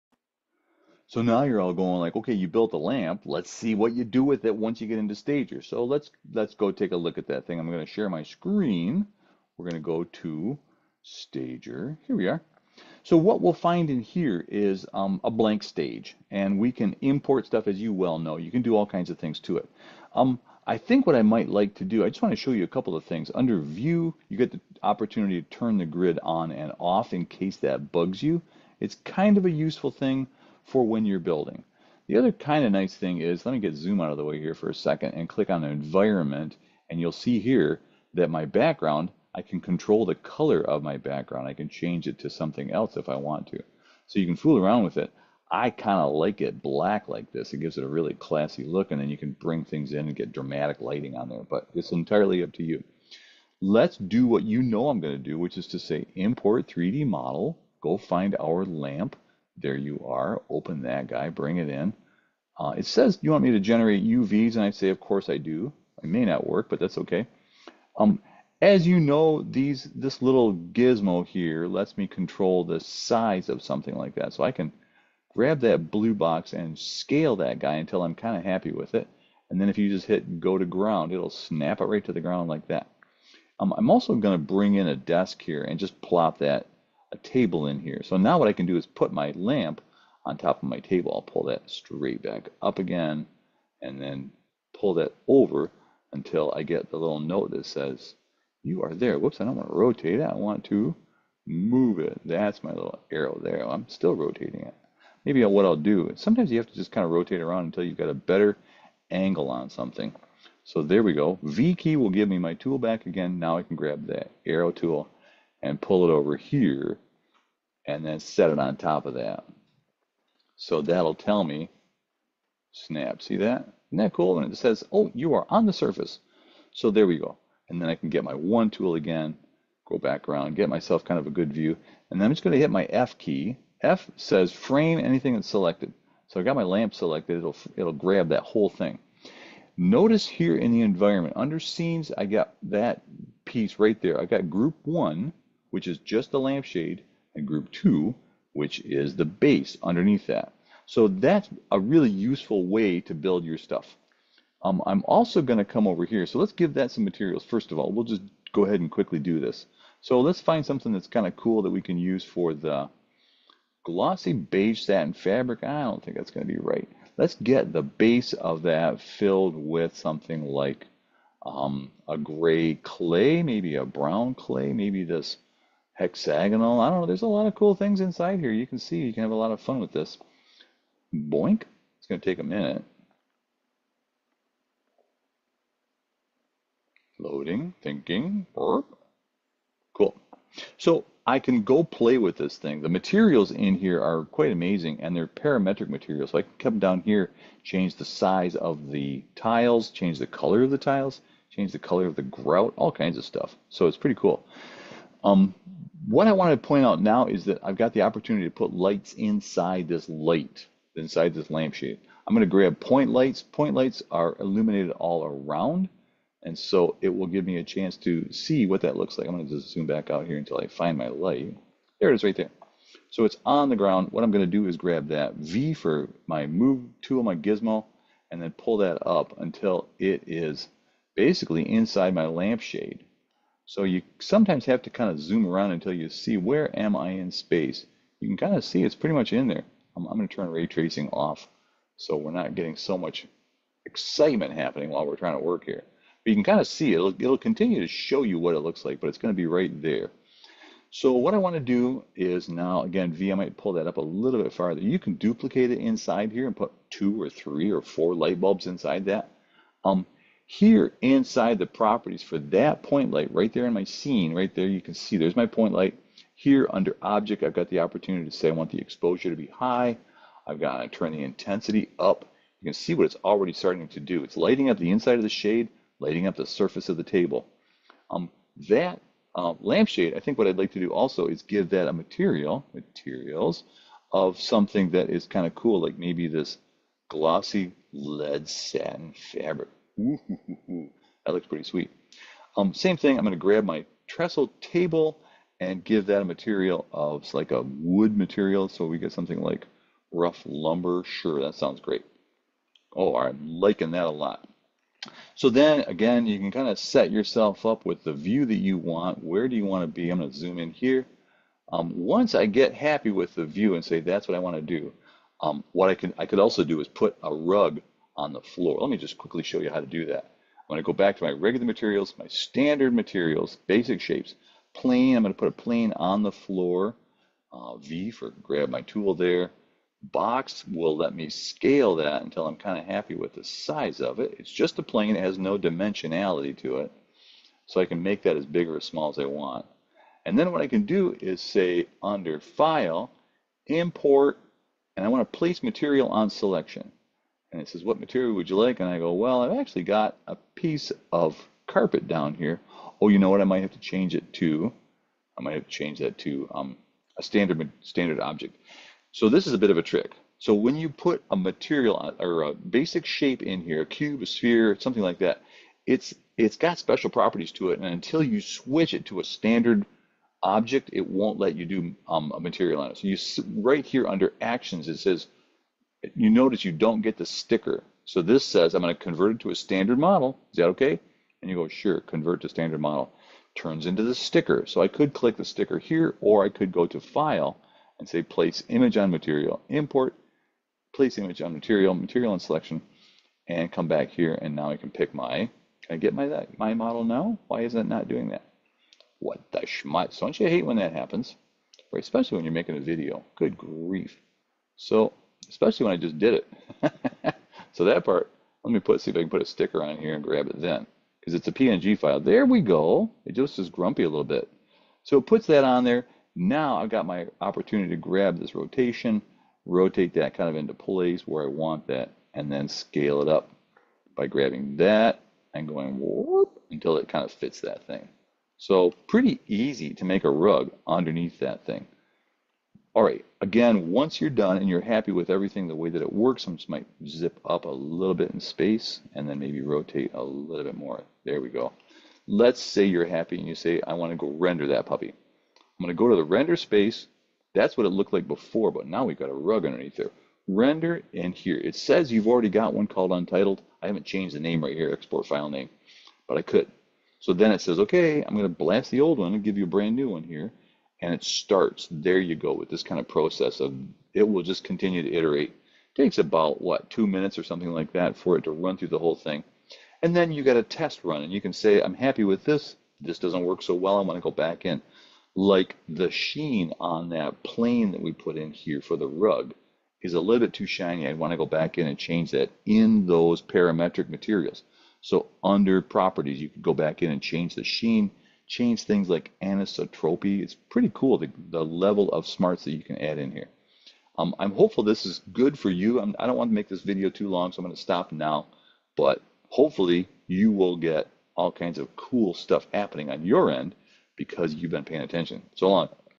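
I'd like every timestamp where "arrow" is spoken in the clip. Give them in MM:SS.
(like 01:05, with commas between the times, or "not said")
01:43, 01:54.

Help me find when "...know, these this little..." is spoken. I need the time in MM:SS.
01:08.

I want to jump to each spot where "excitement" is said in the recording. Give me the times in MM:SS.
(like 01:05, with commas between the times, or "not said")
04:03.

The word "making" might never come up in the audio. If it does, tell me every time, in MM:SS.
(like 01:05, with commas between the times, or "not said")
06:42.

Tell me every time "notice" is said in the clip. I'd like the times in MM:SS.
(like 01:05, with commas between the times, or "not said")
02:19, 06:16.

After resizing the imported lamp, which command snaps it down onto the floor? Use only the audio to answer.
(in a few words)
Go to ground.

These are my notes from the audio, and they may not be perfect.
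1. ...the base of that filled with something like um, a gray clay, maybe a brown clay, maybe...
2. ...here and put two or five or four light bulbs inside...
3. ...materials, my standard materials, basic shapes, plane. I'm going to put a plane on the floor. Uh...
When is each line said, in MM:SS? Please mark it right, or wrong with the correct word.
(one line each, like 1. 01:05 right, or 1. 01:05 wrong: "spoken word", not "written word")
1. 02:47 right
2. 04:16 wrong: "three", not "five"
3. 05:21 right.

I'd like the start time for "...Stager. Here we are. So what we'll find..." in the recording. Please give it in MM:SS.
00:11.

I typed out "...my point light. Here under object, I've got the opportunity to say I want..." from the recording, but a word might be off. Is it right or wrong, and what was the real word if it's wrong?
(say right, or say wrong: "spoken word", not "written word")
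right.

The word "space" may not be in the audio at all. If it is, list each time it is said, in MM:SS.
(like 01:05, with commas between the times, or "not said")
03:57, 07:18, 07:26.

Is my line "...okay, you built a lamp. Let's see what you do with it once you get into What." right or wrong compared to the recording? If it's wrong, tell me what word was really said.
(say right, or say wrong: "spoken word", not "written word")
wrong: "Stager", not "What".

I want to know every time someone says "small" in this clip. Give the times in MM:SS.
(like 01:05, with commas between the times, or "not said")
05:38.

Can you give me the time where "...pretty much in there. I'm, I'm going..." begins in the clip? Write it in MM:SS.
03:58.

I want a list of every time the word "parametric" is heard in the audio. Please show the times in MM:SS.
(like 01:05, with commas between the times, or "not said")
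03:15, 08:03.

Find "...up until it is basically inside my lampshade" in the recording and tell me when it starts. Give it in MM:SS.
03:49.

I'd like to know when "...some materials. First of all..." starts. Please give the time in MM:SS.
02:36.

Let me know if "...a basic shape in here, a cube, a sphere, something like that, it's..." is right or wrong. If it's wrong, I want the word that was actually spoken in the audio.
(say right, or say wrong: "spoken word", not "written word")
right.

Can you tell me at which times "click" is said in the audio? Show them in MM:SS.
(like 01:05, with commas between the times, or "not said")
00:35, 06:25.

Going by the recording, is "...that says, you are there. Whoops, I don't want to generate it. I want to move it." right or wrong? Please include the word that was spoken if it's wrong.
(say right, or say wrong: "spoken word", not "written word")
wrong: "rotate", not "generate".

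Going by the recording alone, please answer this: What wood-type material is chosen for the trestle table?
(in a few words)
Rough lumber.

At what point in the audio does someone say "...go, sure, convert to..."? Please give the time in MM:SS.
06:21.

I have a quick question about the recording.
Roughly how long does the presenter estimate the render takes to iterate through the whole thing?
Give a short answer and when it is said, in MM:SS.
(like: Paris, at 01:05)
About 2 minutes, at 07:46.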